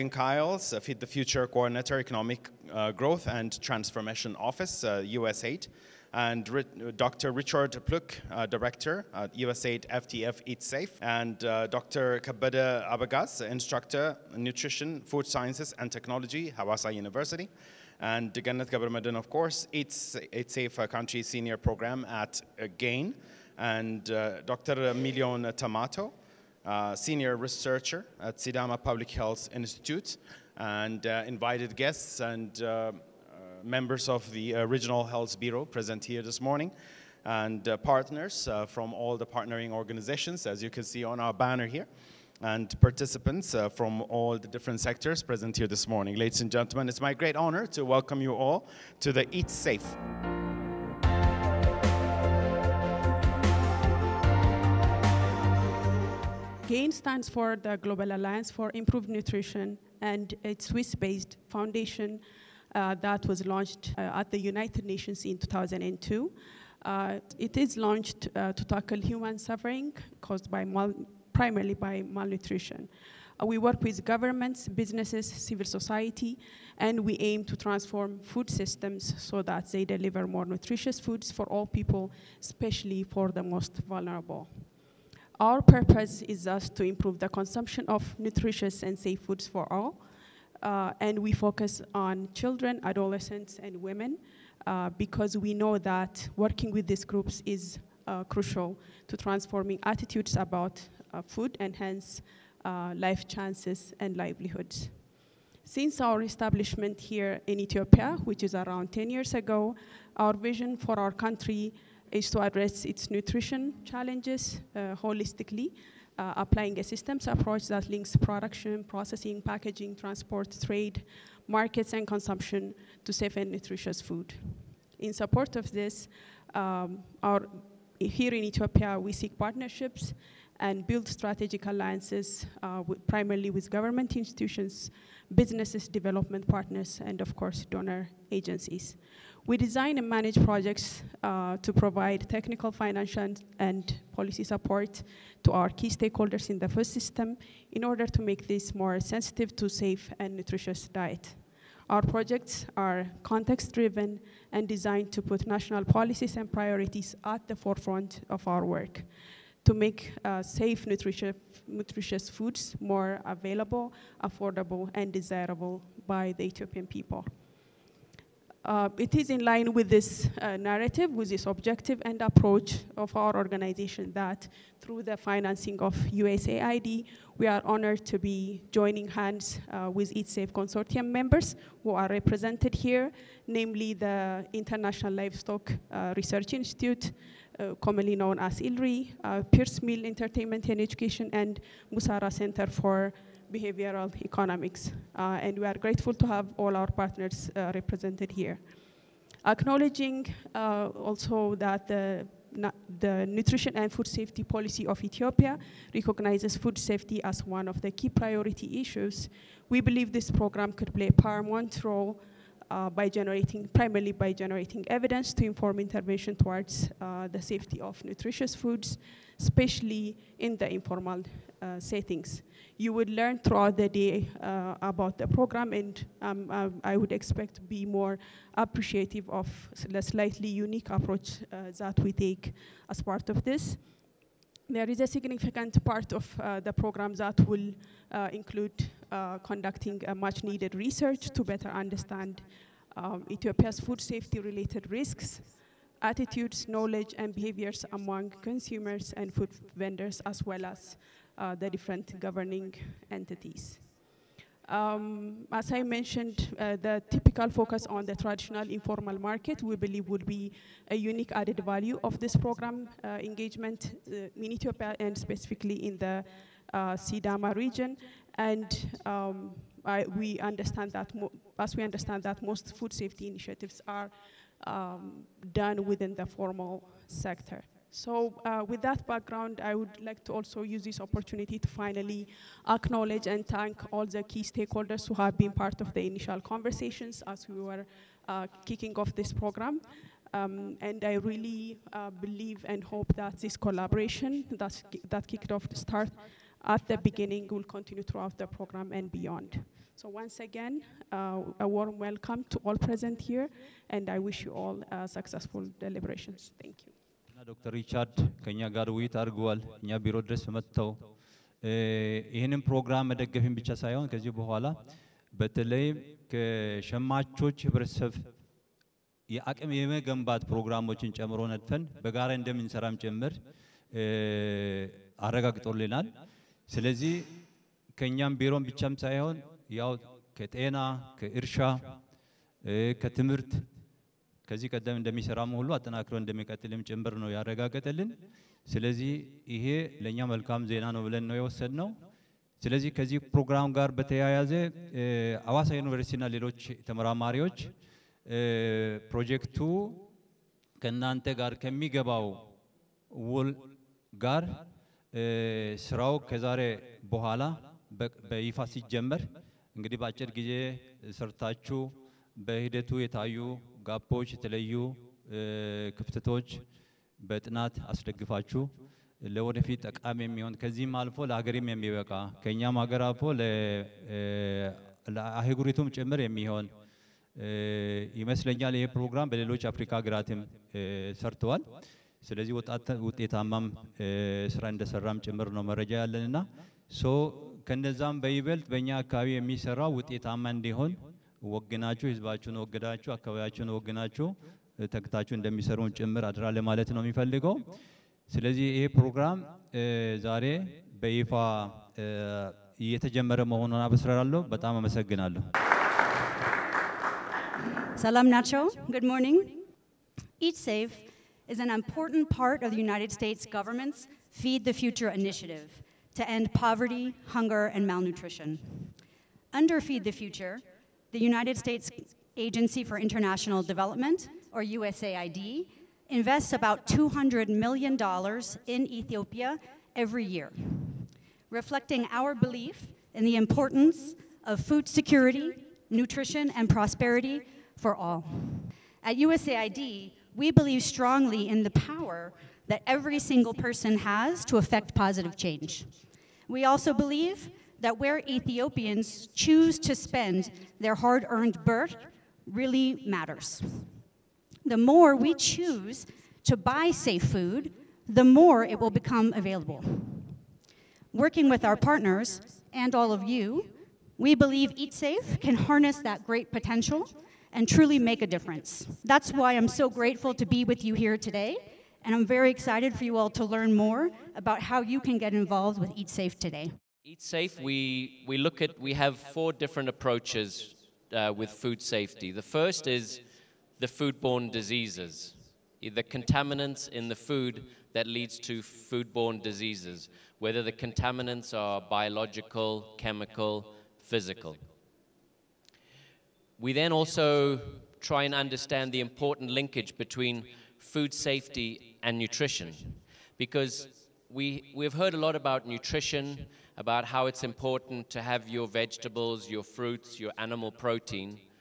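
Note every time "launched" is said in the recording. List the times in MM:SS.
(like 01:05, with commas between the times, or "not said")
01:03, 01:07.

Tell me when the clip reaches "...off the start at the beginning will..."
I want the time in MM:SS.
04:55.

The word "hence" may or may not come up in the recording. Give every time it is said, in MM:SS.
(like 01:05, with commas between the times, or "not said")
01:41.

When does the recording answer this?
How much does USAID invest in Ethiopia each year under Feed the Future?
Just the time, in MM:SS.
07:06.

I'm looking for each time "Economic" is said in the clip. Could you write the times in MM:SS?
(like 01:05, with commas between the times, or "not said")
00:01, 03:14.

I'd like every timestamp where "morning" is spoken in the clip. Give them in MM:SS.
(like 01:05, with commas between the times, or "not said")
00:36, 00:45.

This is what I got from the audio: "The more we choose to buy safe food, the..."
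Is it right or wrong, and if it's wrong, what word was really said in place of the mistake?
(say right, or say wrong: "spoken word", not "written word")
right.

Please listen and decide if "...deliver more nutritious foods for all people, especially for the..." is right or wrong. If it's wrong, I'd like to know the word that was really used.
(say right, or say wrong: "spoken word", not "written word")
right.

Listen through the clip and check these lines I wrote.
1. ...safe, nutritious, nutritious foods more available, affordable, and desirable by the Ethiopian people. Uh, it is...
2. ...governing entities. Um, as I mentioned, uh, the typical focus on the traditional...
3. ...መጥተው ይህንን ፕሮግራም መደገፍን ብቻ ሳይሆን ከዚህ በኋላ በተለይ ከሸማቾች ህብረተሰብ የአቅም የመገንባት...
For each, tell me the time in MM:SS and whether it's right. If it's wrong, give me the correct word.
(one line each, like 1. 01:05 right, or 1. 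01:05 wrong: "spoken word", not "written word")
1. 02:40 right
2. 04:12 right
3. 05:10 right.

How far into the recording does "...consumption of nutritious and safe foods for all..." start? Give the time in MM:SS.
01:27.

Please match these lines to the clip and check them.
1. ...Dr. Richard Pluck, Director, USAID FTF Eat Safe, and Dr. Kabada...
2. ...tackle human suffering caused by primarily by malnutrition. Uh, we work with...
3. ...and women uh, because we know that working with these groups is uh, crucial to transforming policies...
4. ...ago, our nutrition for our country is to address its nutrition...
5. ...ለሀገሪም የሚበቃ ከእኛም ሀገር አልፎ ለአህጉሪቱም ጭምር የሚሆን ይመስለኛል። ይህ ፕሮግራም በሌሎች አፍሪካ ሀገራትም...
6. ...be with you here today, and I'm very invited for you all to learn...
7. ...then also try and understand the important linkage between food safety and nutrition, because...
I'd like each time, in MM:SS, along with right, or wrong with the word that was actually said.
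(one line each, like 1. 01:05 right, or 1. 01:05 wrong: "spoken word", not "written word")
1. 00:06 right
2. 01:08 right
3. 01:33 wrong: "attitudes", not "policies"
4. 01:49 wrong: "vision", not "nutrition"
5. 06:11 right
6. 07:50 wrong: "excited", not "invited"
7. 08:16 right.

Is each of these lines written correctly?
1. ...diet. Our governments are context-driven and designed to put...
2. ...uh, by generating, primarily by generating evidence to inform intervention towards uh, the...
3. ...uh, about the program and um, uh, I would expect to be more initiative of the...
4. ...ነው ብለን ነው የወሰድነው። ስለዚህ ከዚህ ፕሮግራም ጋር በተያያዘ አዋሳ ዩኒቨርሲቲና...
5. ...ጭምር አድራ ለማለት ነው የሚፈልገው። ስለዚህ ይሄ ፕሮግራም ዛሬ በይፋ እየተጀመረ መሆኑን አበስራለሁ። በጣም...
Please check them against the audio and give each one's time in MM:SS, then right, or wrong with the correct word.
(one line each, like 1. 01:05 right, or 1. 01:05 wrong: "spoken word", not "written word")
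1. 02:30 wrong: "projects", not "governments"
2. 03:32 right
3. 03:44 wrong: "appreciative", not "initiative"
4. 05:40 right
5. 06:35 right.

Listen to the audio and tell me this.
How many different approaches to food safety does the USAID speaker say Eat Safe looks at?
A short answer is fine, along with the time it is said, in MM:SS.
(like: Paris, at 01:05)
4, at 07:59.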